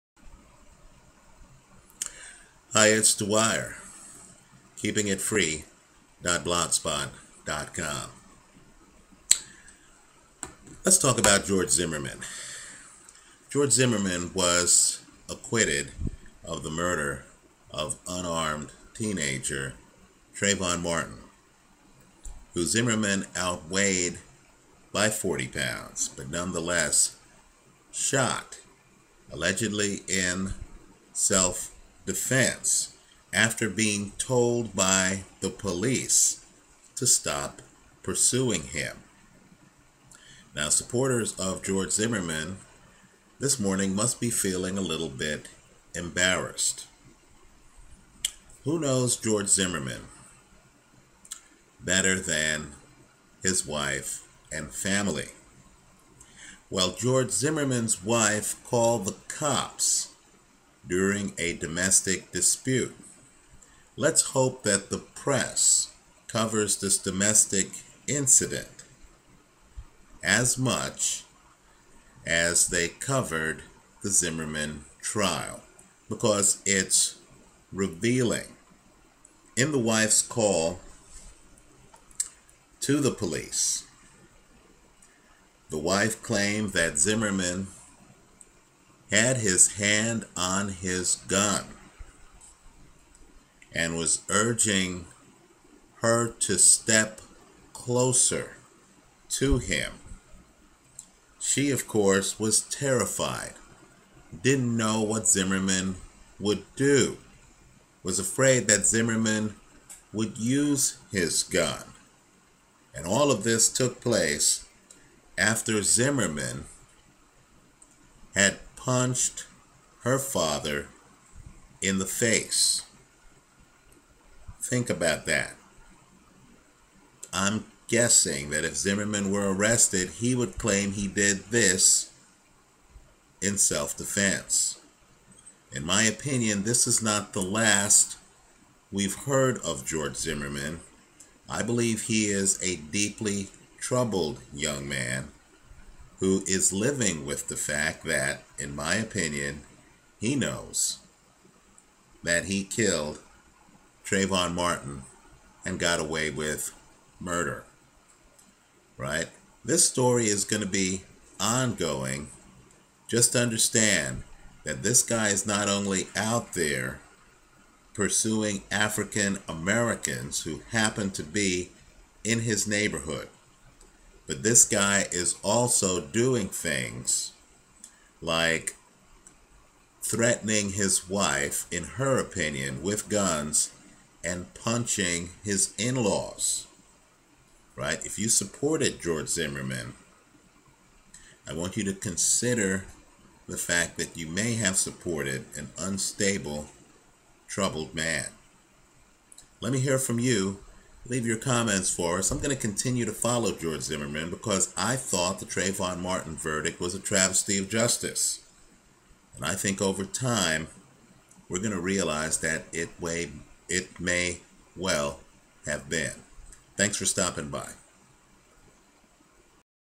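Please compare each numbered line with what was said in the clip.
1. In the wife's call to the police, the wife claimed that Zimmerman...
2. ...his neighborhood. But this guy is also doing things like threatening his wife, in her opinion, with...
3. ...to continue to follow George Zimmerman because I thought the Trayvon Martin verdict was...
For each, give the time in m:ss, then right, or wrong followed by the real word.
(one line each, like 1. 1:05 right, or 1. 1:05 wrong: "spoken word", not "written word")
1. 1:19 right
2. 2:52 right
3. 3:22 right.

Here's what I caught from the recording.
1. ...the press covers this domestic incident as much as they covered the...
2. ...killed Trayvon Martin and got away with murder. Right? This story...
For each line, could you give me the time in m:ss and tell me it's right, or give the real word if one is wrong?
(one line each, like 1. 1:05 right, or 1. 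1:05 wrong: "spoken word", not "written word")
1. 1:04 right
2. 2:32 right.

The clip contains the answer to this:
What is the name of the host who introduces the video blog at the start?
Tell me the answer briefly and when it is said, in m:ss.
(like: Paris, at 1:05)
Dwyer, at 0:03.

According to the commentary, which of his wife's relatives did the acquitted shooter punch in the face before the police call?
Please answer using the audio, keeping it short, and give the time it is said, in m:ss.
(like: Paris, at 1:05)
Her father, at 2:00.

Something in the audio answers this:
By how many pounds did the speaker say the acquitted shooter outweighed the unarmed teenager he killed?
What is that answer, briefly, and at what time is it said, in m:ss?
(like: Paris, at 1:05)
40, at 0:25.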